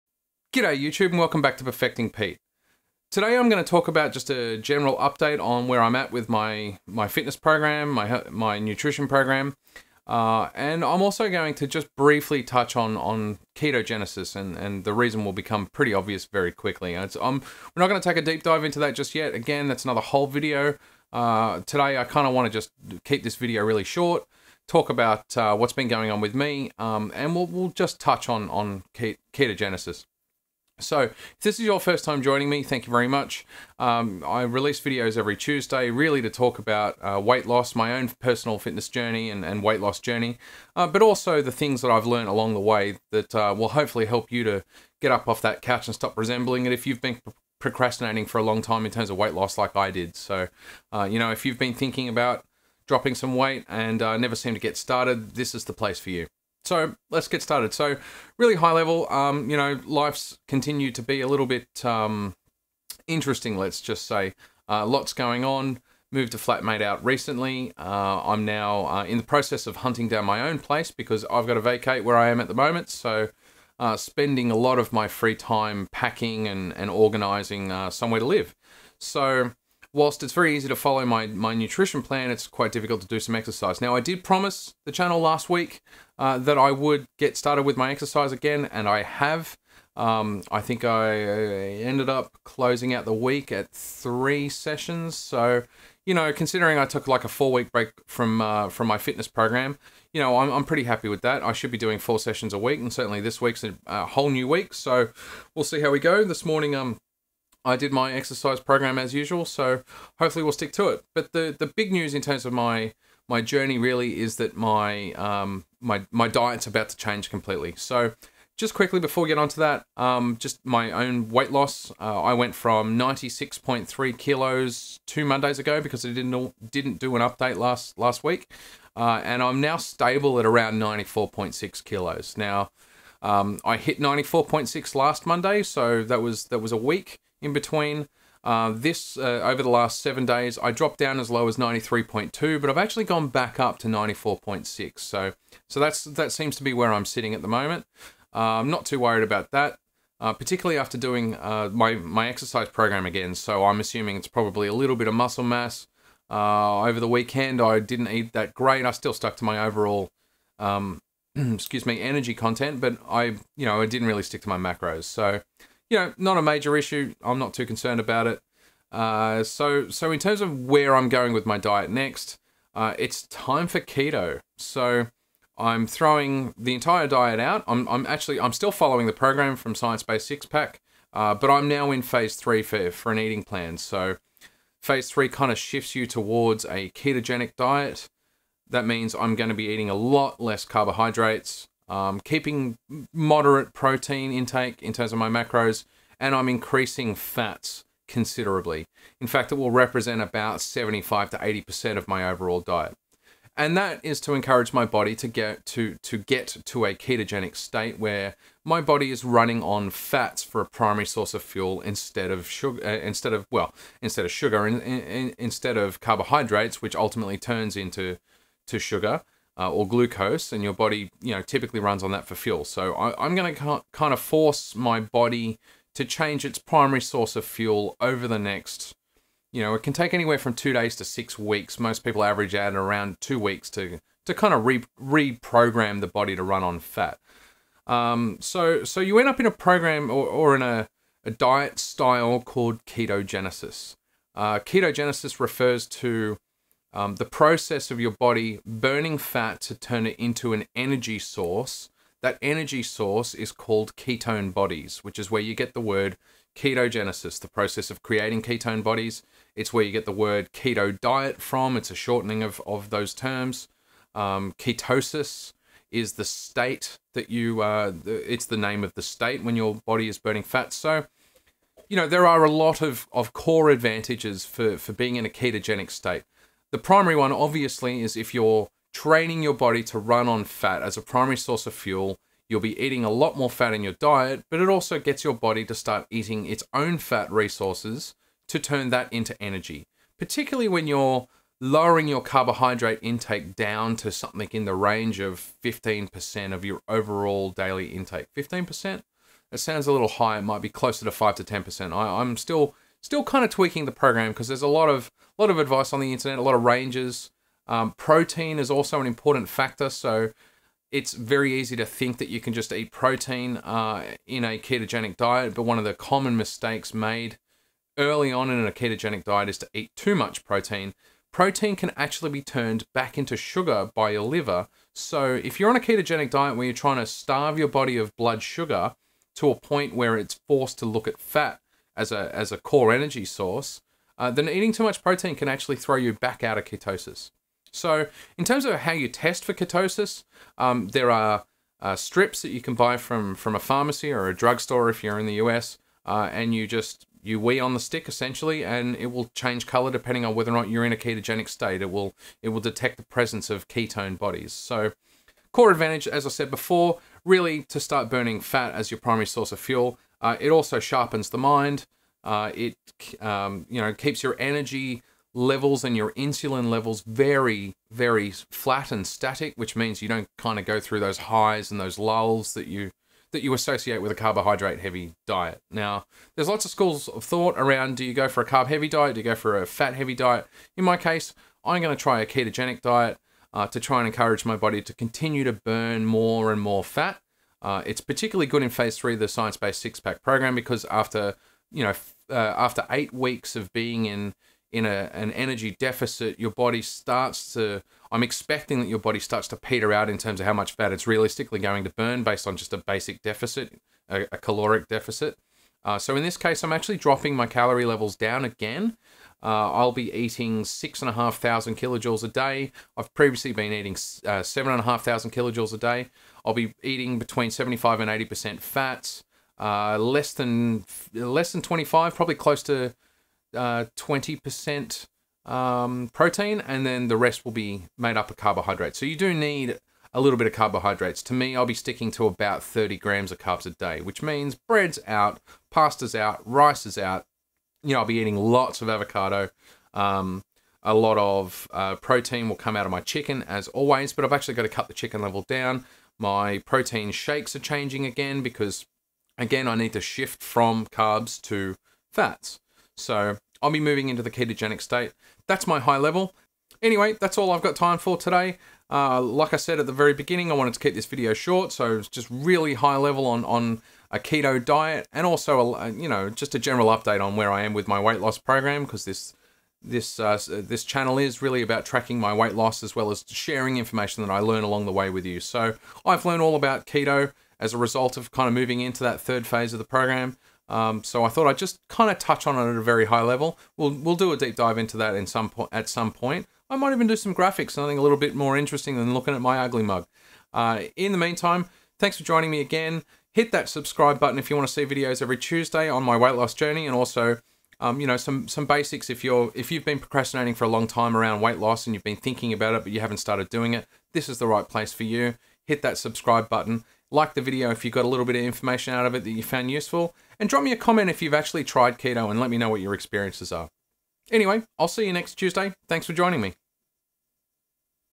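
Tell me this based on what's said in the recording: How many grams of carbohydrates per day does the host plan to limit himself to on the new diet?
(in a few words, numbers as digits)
30 grams.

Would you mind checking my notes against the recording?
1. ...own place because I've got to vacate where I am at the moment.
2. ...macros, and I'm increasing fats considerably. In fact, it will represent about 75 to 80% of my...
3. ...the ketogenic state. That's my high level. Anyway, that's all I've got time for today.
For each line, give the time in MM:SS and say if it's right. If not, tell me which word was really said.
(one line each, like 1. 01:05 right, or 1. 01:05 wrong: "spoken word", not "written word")
1. 01:10 right
2. 03:15 right
3. 07:34 right.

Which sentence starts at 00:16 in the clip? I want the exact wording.
It's, um, we're not going to take a deep dive into that just yet.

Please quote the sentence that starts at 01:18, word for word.
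So, whilst it's very easy to follow my, my nutrition plan, it's quite difficult to do some exercise.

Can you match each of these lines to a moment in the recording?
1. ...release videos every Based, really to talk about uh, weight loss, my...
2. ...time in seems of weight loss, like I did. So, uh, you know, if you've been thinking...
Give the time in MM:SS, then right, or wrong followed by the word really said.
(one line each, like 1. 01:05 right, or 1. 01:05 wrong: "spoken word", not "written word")
1. 00:34 wrong: "Tuesday", not "Based"
2. 00:48 wrong: "terms", not "seems".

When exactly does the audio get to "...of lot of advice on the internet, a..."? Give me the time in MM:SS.
05:04.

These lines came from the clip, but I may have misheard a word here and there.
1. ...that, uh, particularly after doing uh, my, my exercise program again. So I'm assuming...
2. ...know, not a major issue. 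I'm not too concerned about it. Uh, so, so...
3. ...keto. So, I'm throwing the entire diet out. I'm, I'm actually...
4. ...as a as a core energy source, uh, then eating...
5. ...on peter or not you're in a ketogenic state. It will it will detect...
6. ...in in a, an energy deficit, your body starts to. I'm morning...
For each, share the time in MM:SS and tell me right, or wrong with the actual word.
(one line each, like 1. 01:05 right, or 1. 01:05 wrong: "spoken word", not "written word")
1. 02:29 right
2. 02:45 right
3. 02:53 right
4. 05:31 right
5. 05:50 wrong: "whether", not "peter"
6. 06:34 wrong: "expecting", not "morning".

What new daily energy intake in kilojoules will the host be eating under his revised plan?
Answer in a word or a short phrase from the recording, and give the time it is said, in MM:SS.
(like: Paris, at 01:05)
6,500 kilojoules, at 06:50.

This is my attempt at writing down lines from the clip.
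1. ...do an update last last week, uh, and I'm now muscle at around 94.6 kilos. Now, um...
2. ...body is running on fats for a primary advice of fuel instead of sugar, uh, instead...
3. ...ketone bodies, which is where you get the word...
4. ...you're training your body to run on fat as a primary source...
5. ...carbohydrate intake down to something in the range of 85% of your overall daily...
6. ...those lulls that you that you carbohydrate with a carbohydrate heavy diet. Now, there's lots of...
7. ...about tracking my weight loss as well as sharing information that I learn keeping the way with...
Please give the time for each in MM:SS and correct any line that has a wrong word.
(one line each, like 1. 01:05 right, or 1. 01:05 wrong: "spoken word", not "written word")
1. 02:06 wrong: "stable", not "muscle"
2. 03:28 wrong: "source", not "advice"
3. 04:13 right
4. 04:38 right
5. 04:52 wrong: "15", not "85"
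6. 06:11 wrong: "associate", not "carbohydrate"
7. 07:51 wrong: "along", not "keeping".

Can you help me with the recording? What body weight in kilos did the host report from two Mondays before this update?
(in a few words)
96.3 kilos.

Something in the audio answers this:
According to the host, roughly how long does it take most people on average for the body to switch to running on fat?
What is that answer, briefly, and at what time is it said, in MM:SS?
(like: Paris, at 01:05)
2 weeks, at 03:53.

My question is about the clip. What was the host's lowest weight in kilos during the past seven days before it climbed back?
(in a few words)
93.2.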